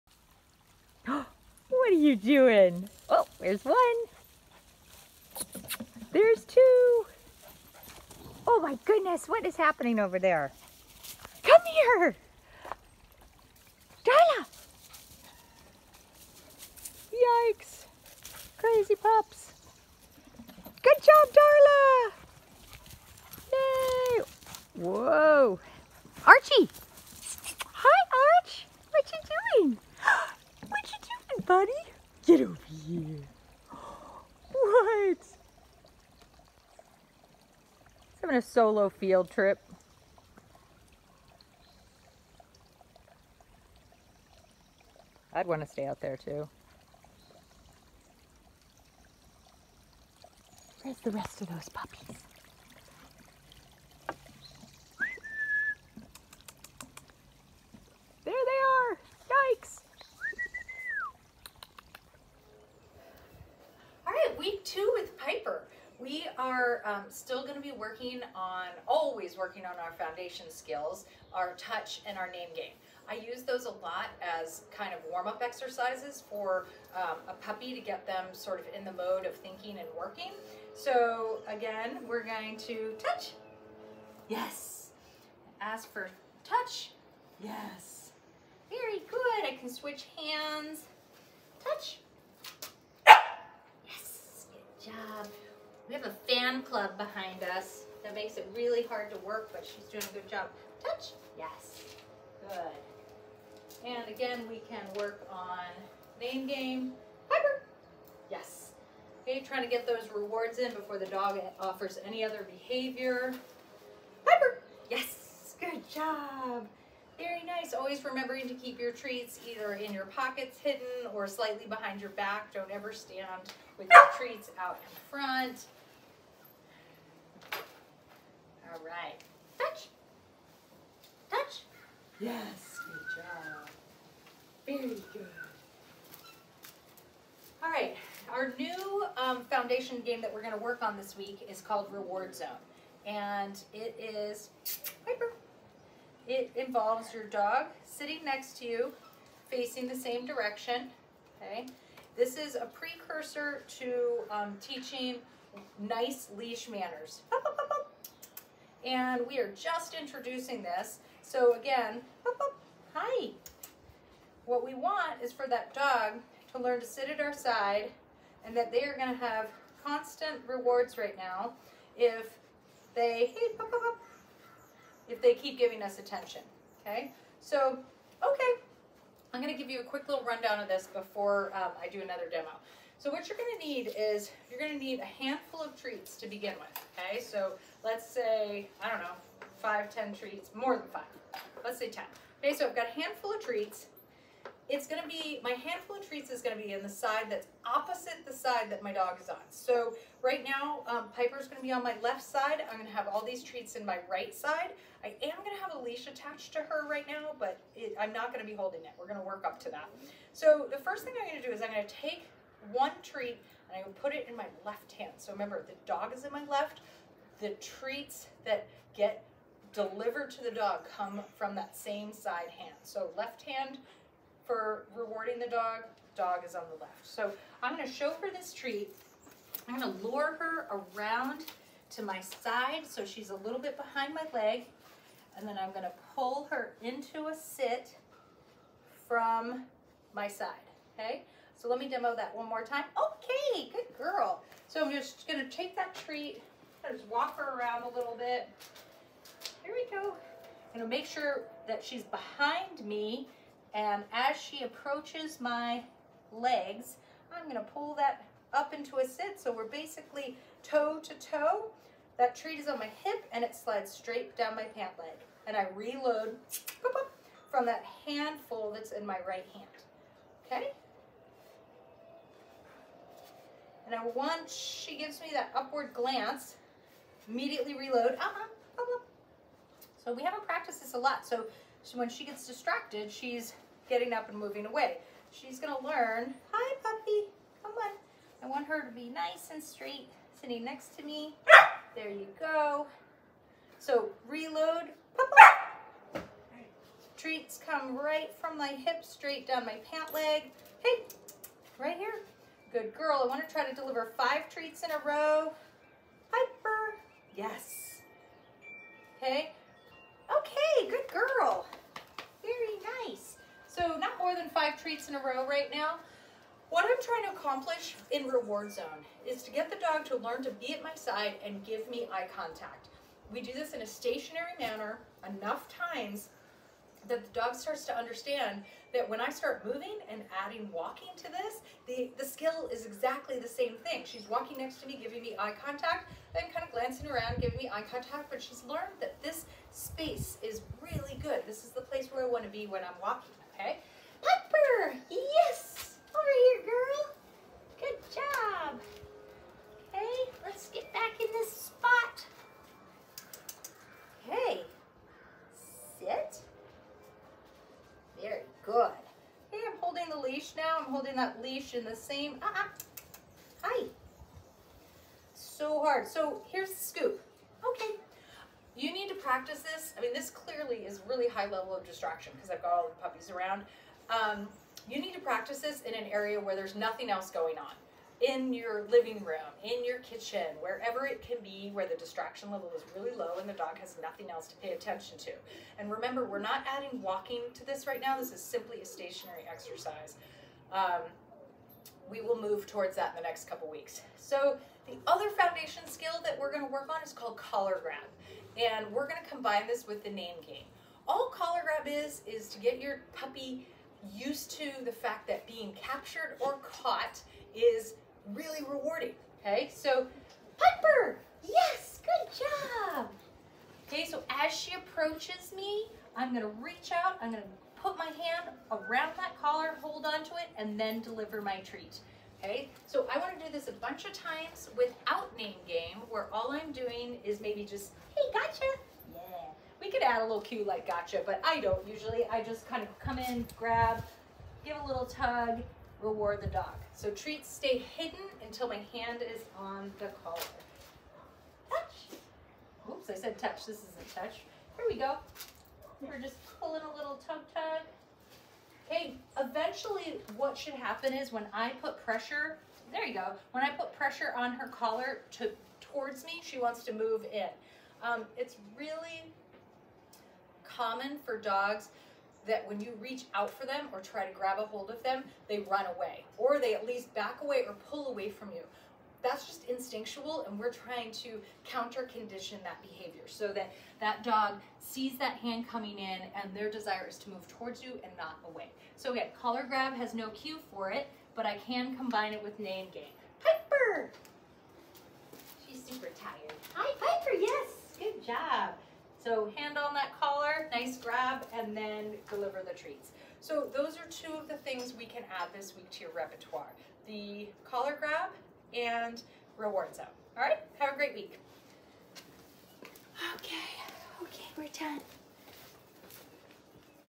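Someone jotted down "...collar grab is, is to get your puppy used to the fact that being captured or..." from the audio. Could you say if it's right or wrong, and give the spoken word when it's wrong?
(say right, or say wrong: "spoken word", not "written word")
right.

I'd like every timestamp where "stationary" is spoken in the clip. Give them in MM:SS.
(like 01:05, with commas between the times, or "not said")
05:23, 06:28.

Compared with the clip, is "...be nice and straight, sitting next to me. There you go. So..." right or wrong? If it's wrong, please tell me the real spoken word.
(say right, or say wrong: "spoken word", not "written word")
right.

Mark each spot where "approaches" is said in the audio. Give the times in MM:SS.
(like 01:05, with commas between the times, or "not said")
04:14, 06:54.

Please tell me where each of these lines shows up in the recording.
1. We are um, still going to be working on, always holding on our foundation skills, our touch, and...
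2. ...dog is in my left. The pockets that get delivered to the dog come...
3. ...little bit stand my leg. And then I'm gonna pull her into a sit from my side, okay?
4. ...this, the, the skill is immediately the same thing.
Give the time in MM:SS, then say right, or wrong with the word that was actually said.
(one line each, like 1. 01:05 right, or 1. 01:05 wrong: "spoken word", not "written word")
1. 01:05 wrong: "working", not "holding"
2. 03:35 wrong: "treats", not "pockets"
3. 03:53 wrong: "behind", not "stand"
4. 05:31 wrong: "exactly", not "immediately".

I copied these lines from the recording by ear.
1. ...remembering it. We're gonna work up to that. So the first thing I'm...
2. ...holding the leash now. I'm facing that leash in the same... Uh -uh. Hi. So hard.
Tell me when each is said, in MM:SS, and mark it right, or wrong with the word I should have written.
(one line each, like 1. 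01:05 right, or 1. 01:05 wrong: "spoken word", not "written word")
1. 03:28 wrong: "holding", not "remembering"
2. 05:59 wrong: "holding", not "facing".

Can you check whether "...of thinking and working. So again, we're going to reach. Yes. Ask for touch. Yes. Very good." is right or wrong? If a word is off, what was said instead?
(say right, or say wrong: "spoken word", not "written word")
wrong: "touch", not "reach".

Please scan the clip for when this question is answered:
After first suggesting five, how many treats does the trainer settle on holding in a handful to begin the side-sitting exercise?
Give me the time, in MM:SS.
03:11.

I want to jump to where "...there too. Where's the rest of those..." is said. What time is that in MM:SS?
00:46.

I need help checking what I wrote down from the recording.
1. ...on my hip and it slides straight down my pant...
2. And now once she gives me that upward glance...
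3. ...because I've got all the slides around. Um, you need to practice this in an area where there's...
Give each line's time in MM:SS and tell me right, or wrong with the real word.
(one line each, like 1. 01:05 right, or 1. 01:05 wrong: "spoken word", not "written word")
1. 04:22 right
2. 04:33 right
3. 06:12 wrong: "puppies", not "slides".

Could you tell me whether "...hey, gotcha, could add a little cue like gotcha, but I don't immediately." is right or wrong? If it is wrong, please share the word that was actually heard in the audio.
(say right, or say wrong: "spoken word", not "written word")
wrong: "usually", not "immediately".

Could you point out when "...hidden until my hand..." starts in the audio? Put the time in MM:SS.
07:17.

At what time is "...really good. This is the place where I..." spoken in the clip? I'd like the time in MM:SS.
05:40.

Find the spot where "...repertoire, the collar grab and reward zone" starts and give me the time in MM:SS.
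08:16.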